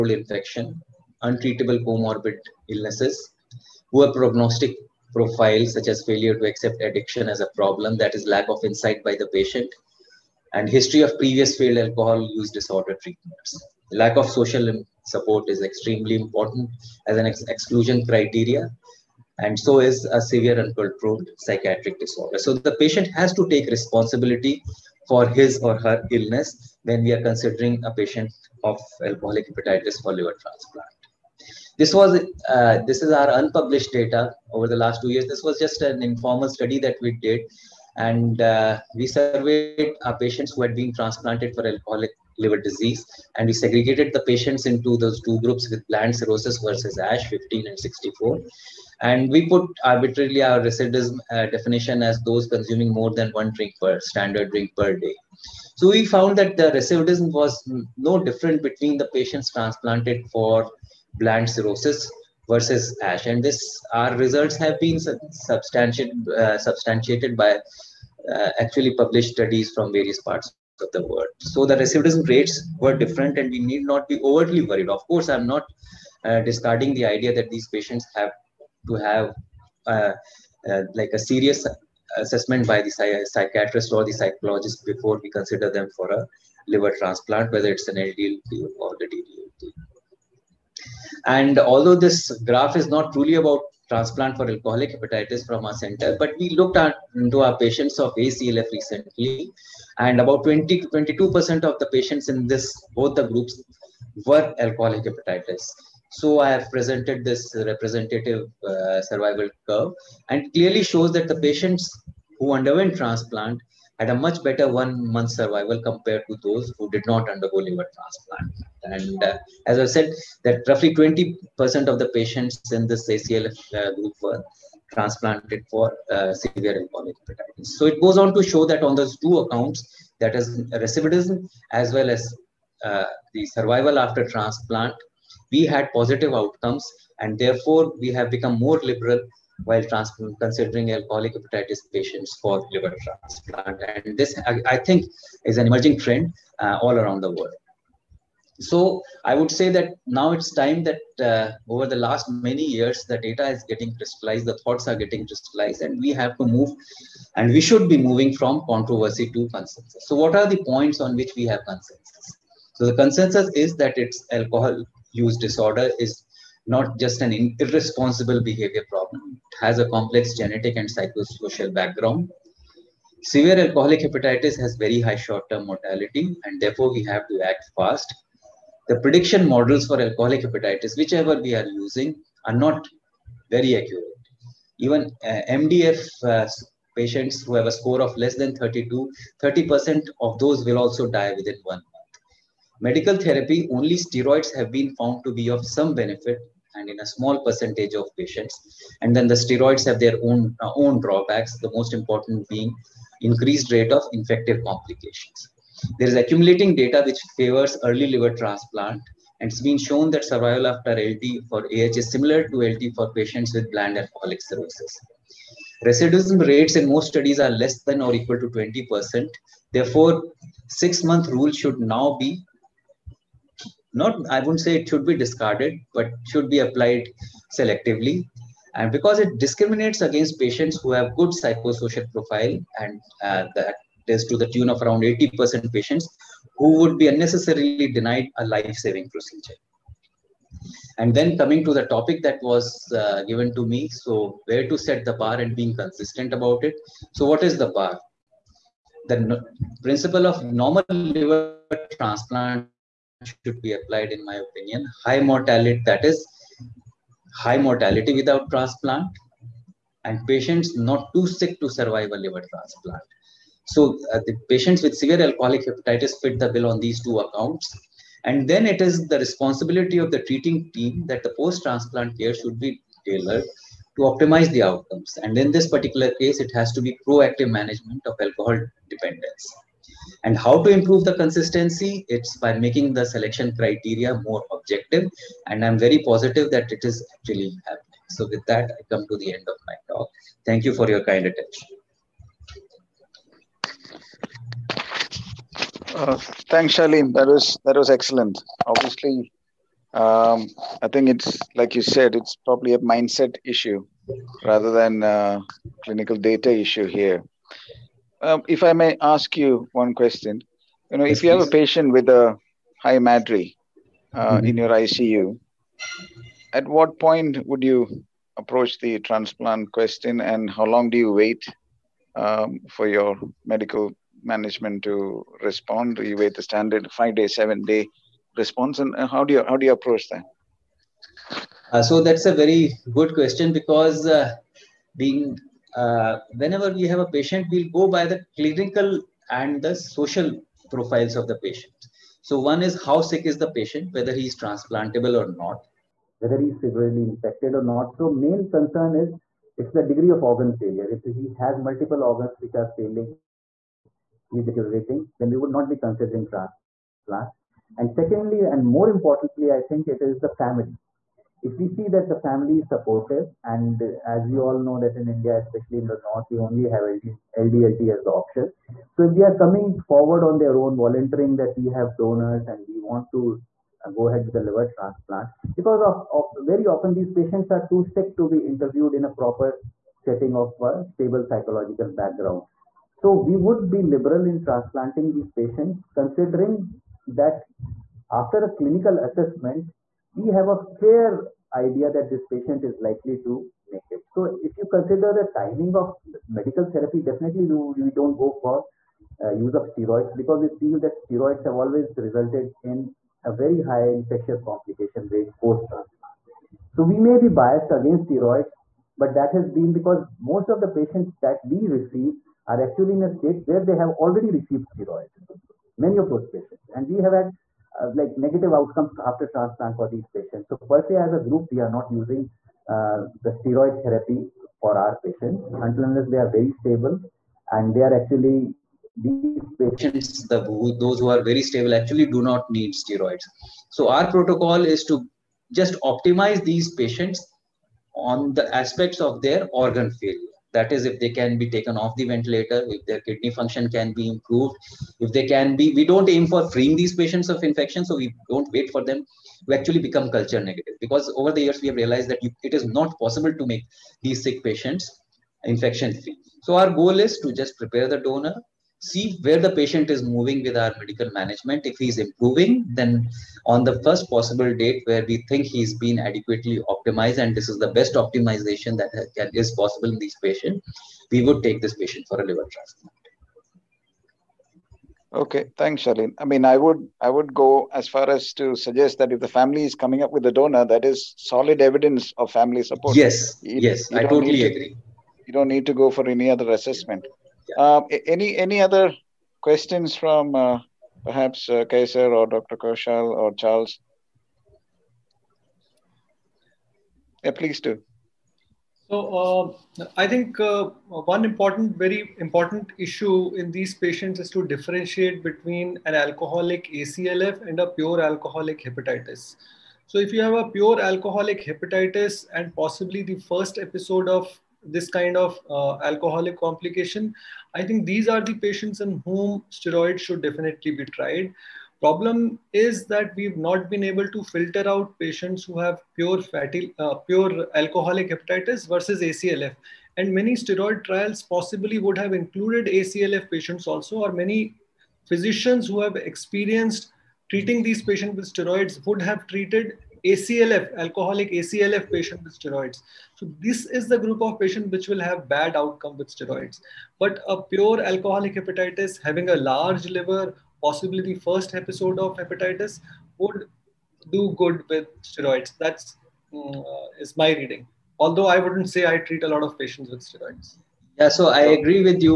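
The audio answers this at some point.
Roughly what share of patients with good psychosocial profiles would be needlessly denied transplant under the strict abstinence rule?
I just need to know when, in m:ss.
3:55.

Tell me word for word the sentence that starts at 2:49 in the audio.
It has a complex genetic and psychosocial background.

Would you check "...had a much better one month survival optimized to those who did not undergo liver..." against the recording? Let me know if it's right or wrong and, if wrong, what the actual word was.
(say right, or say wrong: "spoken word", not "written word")
wrong: "compared", not "optimized".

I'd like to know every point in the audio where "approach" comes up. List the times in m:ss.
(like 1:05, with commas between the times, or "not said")
5:18, 5:29.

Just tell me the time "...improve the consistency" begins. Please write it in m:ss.
4:40.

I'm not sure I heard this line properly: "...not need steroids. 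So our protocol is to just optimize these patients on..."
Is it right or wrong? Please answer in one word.
right.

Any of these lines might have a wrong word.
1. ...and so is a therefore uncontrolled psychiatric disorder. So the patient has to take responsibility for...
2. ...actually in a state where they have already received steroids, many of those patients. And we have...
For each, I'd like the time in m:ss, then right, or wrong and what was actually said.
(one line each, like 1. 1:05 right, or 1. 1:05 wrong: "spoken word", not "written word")
1. 0:19 wrong: "severe", not "therefore"
2. 6:52 right.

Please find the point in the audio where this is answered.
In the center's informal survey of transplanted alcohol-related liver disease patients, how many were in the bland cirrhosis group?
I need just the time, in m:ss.
0:47.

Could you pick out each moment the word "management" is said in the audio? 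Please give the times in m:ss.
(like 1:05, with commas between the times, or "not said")
4:37, 5:24, 7:41.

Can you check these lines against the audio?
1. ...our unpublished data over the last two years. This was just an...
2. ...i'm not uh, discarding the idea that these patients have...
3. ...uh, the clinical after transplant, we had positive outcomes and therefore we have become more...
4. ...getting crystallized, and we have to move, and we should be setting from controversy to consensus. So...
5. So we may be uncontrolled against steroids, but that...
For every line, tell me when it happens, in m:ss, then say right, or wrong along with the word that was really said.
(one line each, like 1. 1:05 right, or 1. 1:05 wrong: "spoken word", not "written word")
1. 0:33 right
2. 1:15 right
3. 2:12 wrong: "survival", not "clinical"
4. 2:34 wrong: "moving", not "setting"
5. 6:46 wrong: "biased", not "uncontrolled".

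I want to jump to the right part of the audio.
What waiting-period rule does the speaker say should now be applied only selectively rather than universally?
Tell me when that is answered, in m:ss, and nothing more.
3:40.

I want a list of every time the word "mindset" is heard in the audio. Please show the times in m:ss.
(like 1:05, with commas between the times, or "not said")
5:02.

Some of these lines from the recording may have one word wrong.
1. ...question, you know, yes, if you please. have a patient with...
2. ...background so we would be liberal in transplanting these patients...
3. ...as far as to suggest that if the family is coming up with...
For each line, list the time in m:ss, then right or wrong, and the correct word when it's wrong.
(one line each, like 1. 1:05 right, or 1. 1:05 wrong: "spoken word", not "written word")
1. 5:09 right
2. 6:21 right
3. 7:57 right.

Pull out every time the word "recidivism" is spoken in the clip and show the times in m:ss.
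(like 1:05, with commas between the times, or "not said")
0:50, 0:56, 1:11, 2:10, 3:35.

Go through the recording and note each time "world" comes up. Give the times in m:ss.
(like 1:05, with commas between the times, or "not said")
1:11, 2:27.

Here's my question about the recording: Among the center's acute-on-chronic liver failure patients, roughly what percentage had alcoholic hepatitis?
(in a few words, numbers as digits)
20 to 22%.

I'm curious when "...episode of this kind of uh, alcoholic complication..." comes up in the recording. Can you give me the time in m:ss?
8:33.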